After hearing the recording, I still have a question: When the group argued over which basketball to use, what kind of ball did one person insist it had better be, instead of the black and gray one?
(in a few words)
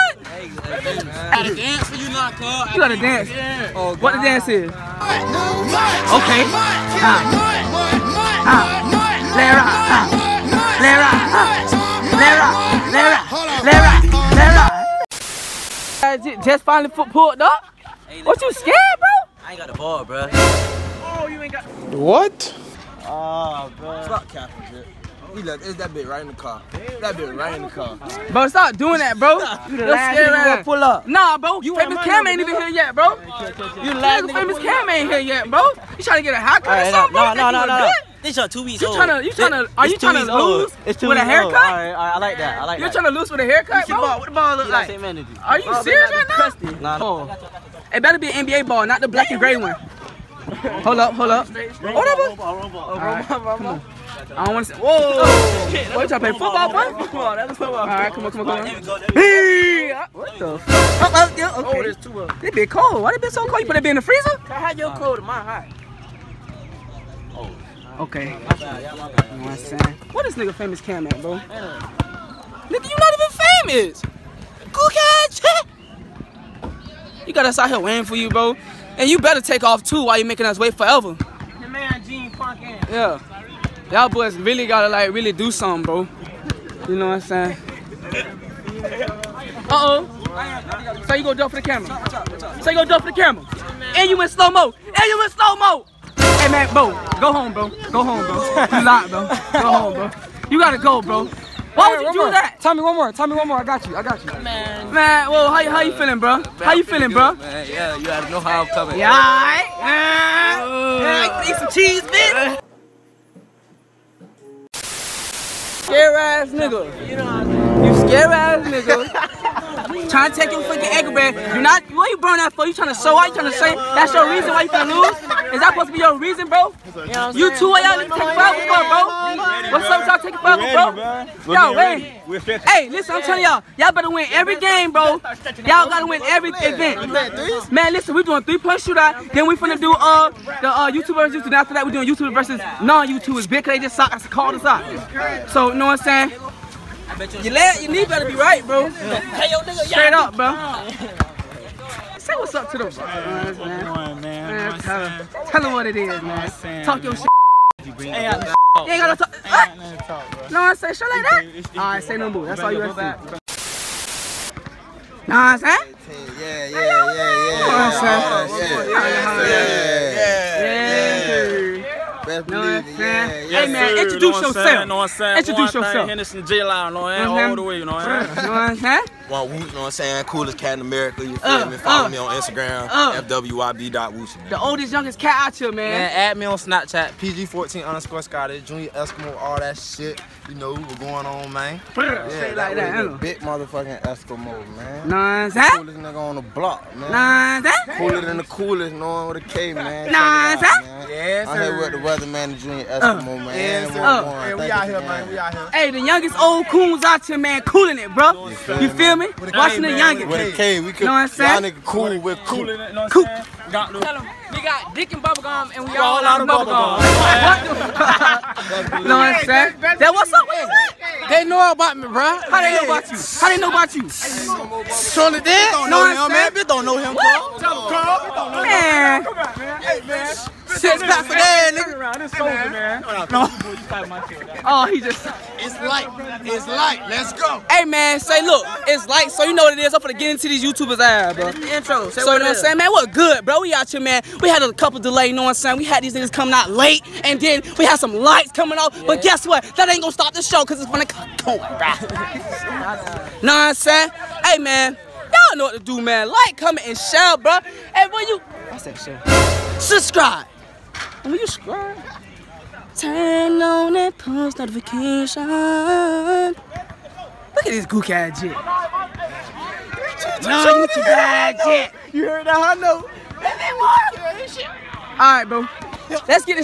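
NBA ball.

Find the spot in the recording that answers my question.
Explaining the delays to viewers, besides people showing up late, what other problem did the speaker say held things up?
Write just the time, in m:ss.
4:07.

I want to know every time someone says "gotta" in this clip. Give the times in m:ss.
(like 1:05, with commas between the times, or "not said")
0:01, 1:24, 1:40, 1:48, 2:15.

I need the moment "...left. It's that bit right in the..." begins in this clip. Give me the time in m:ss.
0:25.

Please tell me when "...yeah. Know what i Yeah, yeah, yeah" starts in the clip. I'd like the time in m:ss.
2:47.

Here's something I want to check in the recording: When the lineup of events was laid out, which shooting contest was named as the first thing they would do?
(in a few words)
Three-point shootout.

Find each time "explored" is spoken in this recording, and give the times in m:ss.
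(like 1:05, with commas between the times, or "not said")
not said.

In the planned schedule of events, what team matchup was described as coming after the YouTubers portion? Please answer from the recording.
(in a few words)
YouTube versus non-YouTubers.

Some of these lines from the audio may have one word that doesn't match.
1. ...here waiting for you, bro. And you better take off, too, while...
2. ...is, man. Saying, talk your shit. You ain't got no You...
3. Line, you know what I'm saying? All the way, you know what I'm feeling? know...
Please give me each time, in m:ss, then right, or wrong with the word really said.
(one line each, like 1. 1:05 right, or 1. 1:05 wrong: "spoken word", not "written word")
1. 1:17 right
2. 2:35 right
3. 2:56 wrong: "saying", not "feeling".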